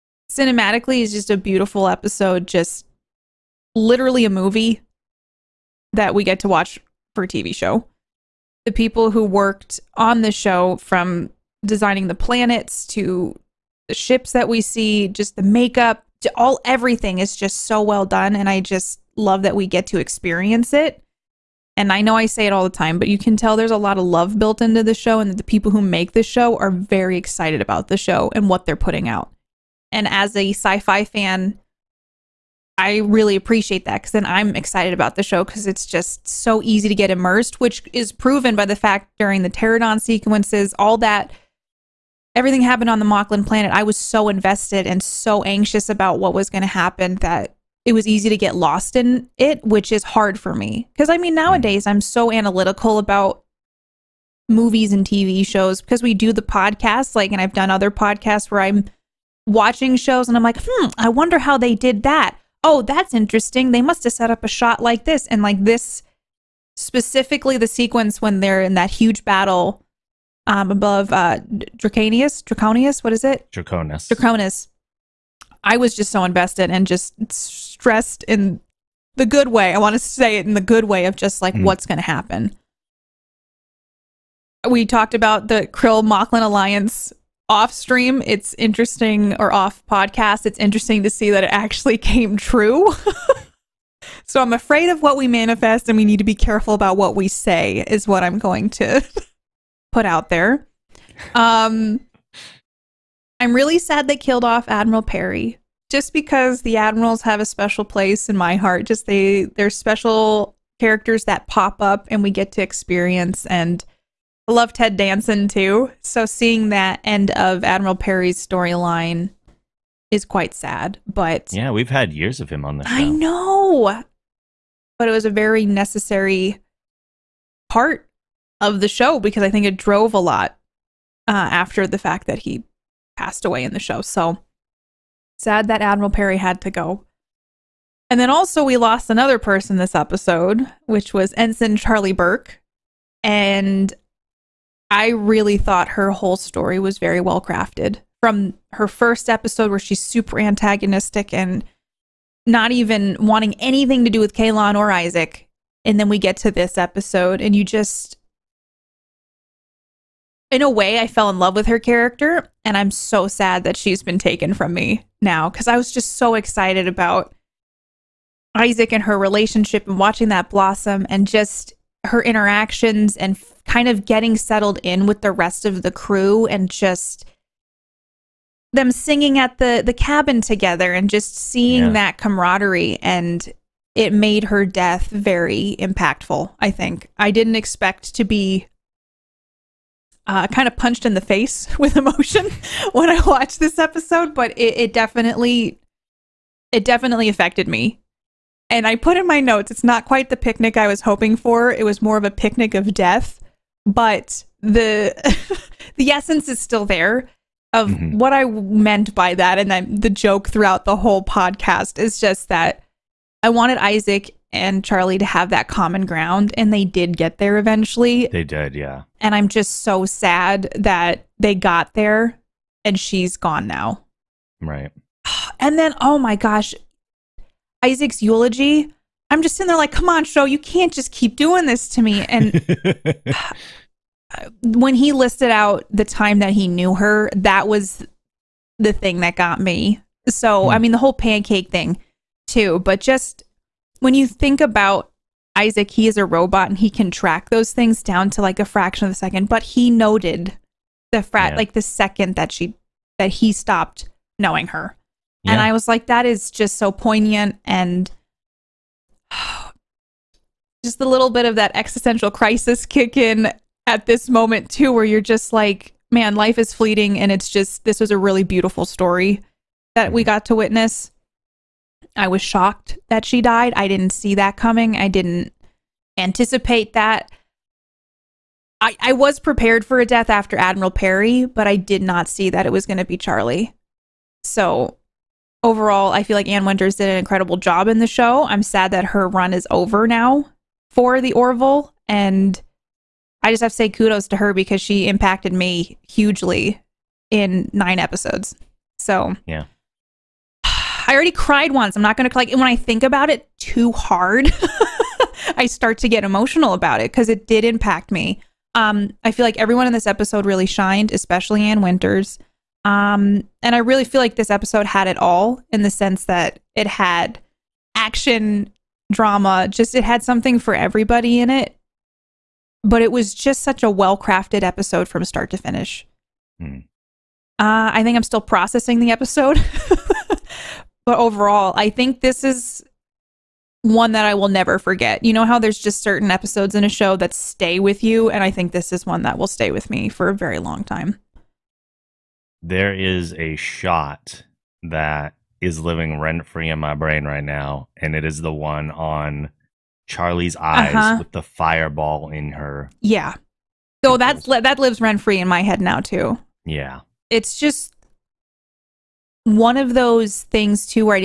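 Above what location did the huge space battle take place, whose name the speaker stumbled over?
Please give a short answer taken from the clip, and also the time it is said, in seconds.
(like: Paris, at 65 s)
Draconis, at 73 s.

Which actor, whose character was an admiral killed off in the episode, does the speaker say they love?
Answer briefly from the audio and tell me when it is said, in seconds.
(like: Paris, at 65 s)
Ted Danson, at 114 s.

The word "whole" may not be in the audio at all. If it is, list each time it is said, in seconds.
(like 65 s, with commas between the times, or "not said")
146 s, 210 s, 240 s.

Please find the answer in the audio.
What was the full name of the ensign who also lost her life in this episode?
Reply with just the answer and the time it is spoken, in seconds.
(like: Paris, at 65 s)
Charlie Burke, at 141 s.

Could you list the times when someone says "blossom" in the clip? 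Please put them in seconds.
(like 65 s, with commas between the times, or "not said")
170 s.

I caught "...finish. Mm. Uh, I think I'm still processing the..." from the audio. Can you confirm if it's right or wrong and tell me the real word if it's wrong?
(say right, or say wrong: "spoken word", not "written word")
right.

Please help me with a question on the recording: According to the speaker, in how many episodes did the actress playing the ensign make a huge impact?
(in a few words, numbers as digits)
9.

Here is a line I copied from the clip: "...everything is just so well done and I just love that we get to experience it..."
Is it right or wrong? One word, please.
right.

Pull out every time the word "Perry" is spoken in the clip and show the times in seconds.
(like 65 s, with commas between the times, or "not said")
105 s, 117 s, 136 s, 280 s.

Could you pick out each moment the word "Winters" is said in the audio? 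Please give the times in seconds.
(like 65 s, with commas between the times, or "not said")
286 s, 311 s.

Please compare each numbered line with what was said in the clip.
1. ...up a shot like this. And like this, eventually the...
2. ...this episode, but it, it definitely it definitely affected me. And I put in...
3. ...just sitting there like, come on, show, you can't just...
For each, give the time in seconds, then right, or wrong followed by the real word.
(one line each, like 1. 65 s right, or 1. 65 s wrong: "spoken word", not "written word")
1. 64 s wrong: "specifically", not "eventually"
2. 193 s right
3. 229 s right.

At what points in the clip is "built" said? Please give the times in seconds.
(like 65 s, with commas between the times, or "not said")
24 s.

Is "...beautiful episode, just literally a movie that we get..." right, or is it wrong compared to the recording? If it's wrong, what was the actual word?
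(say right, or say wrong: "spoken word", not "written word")
right.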